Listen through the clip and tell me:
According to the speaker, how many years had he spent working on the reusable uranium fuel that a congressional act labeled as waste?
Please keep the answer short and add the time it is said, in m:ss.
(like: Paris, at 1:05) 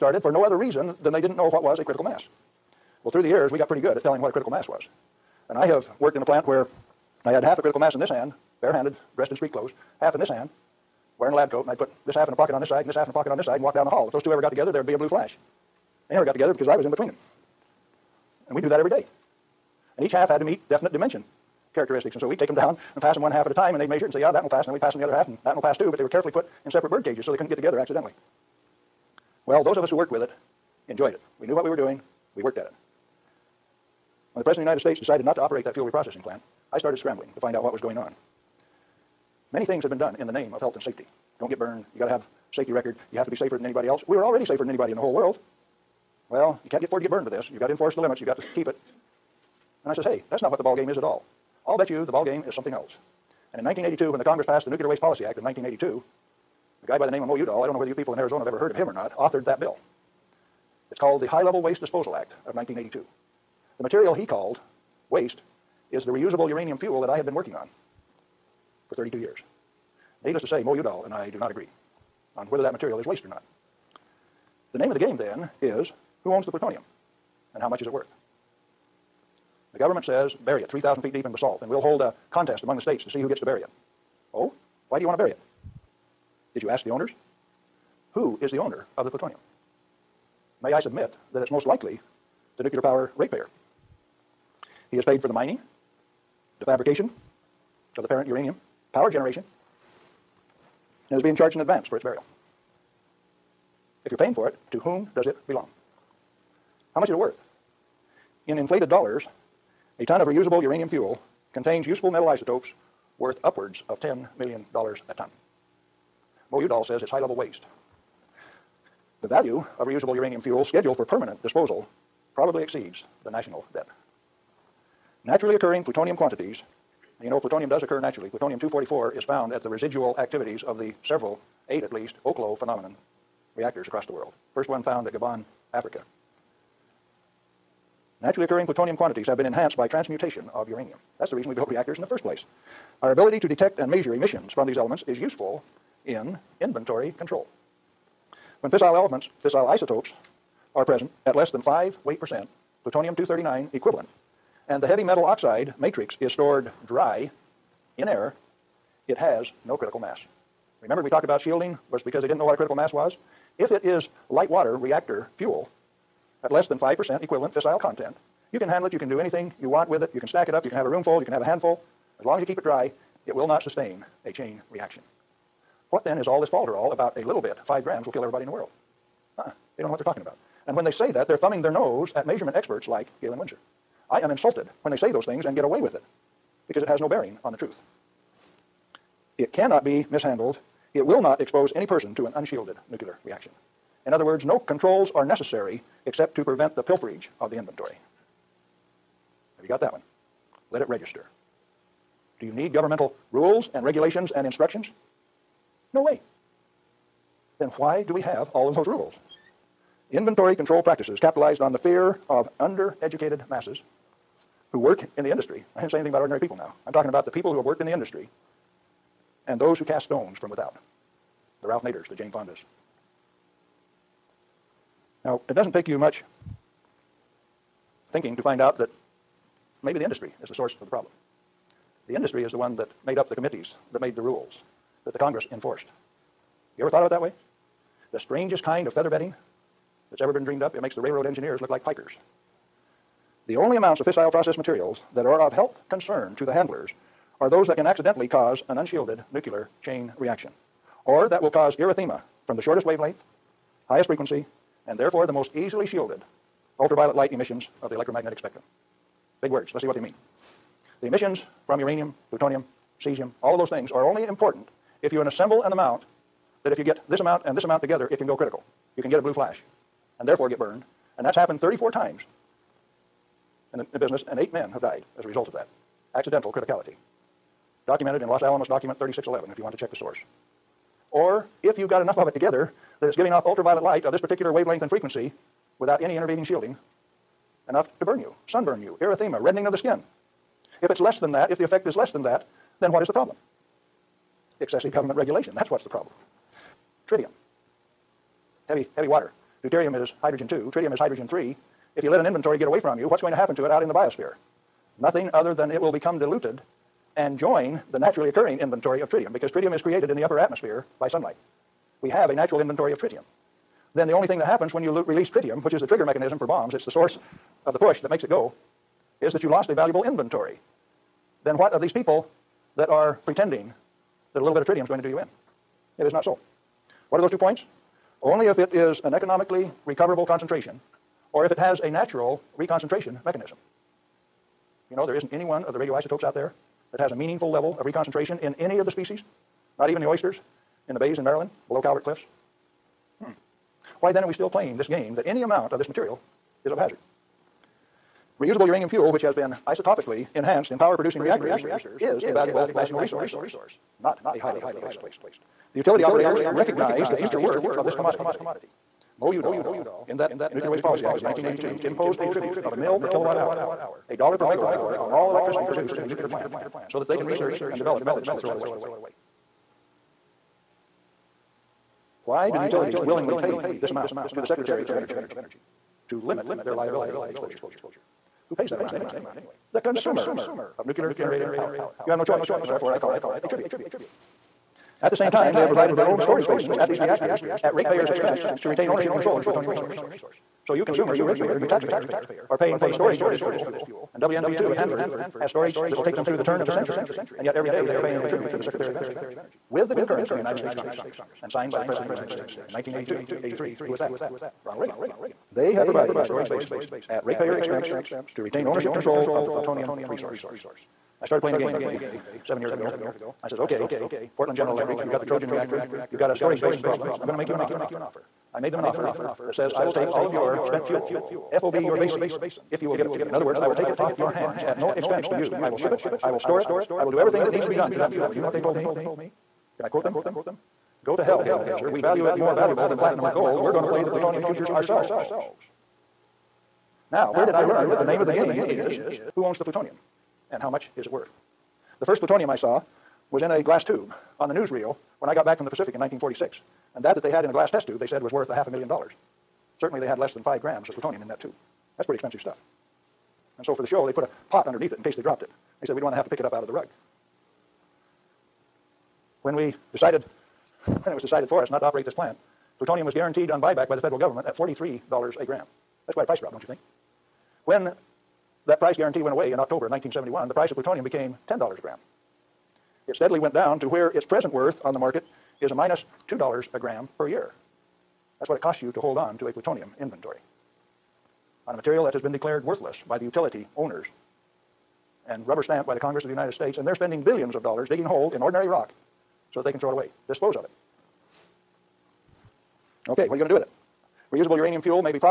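32 years, at 1:08.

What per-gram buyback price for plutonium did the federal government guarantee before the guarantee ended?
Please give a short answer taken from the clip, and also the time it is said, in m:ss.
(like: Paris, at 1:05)
$43 a gram, at 7:44.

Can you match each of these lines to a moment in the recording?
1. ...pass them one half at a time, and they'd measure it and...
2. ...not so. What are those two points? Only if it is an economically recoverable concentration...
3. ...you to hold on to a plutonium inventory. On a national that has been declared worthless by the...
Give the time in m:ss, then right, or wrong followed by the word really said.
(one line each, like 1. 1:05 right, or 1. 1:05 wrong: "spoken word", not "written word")
1. 0:23 right
2. 5:26 right
3. 7:58 wrong: "material", not "national".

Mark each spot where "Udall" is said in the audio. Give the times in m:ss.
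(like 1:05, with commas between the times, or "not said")
0:57, 1:10, 1:56, 5:59.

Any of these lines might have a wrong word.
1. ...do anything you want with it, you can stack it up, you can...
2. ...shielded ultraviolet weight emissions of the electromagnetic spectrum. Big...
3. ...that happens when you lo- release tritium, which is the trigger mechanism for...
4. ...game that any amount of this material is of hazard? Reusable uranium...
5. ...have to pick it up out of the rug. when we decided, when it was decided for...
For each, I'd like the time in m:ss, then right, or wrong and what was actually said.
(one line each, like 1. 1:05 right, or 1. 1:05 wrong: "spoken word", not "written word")
1. 2:49 right
2. 4:15 wrong: "light", not "weight"
3. 5:14 right
4. 5:44 right
5. 7:36 right.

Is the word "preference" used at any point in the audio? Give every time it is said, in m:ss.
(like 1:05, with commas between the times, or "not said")
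not said.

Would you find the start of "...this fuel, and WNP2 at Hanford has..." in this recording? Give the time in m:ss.
6:33.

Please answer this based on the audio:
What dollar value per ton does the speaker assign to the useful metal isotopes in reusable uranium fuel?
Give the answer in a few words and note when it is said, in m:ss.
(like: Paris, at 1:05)
$10 million, at 1:54.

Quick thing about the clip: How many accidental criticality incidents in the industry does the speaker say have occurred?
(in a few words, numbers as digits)
34.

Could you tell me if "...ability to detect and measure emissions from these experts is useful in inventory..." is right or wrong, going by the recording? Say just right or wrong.
wrong.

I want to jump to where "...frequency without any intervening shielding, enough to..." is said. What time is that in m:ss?
4:44.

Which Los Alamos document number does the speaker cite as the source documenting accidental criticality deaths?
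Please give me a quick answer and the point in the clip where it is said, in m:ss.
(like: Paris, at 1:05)
3611, at 4:39.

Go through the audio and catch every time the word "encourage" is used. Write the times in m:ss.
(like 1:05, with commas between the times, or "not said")
not said.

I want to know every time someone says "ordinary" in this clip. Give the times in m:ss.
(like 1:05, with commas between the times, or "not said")
3:36, 8:08.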